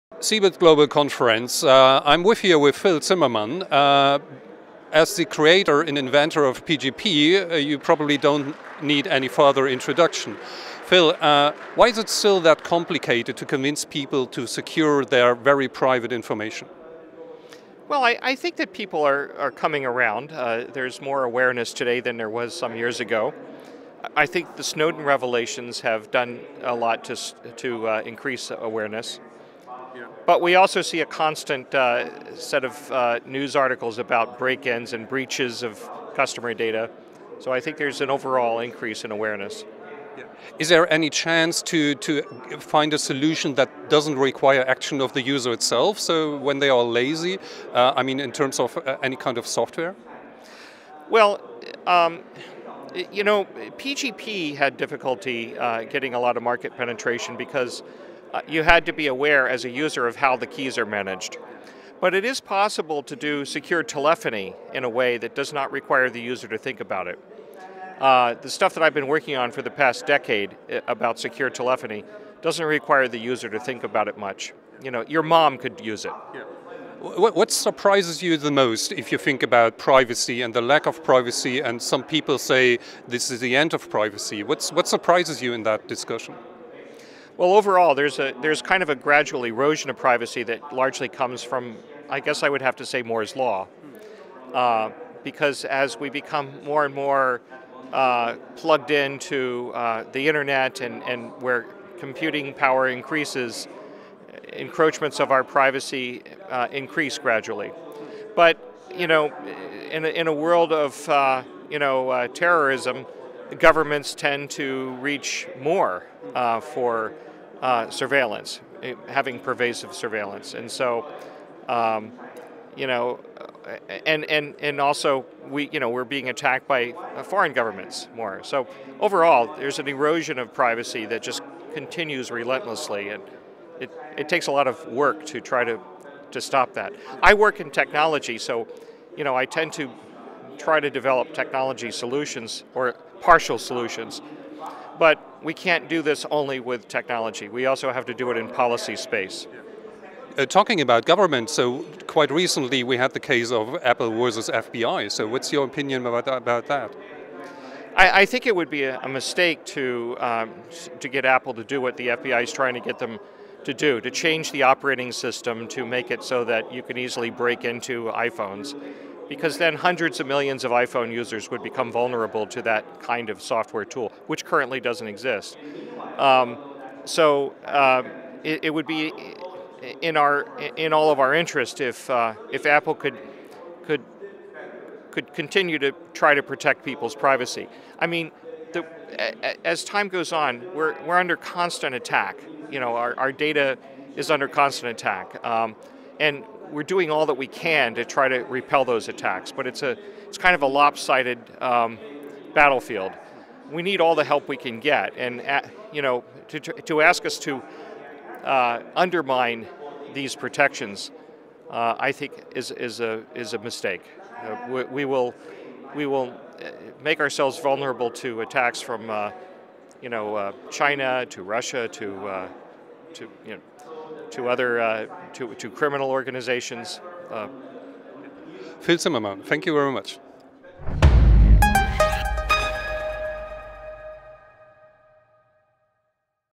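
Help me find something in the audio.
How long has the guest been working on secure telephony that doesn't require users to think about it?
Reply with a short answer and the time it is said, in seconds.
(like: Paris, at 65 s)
past decade, at 69 s.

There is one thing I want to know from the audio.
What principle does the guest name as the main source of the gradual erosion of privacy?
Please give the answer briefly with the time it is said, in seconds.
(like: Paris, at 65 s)
Moore's law, at 93 s.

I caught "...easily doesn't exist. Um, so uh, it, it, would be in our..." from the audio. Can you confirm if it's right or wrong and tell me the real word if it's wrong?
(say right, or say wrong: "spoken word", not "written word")
wrong: "currently", not "easily".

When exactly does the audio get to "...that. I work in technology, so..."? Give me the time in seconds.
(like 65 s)
136 s.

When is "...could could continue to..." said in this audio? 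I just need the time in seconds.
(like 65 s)
183 s.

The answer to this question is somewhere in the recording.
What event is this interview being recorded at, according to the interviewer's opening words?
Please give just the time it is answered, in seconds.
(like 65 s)
0 s.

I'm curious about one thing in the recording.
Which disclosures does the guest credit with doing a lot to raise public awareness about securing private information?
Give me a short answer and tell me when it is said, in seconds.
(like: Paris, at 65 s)
Snowden revelations, at 24 s.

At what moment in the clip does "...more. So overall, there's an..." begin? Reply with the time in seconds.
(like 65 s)
128 s.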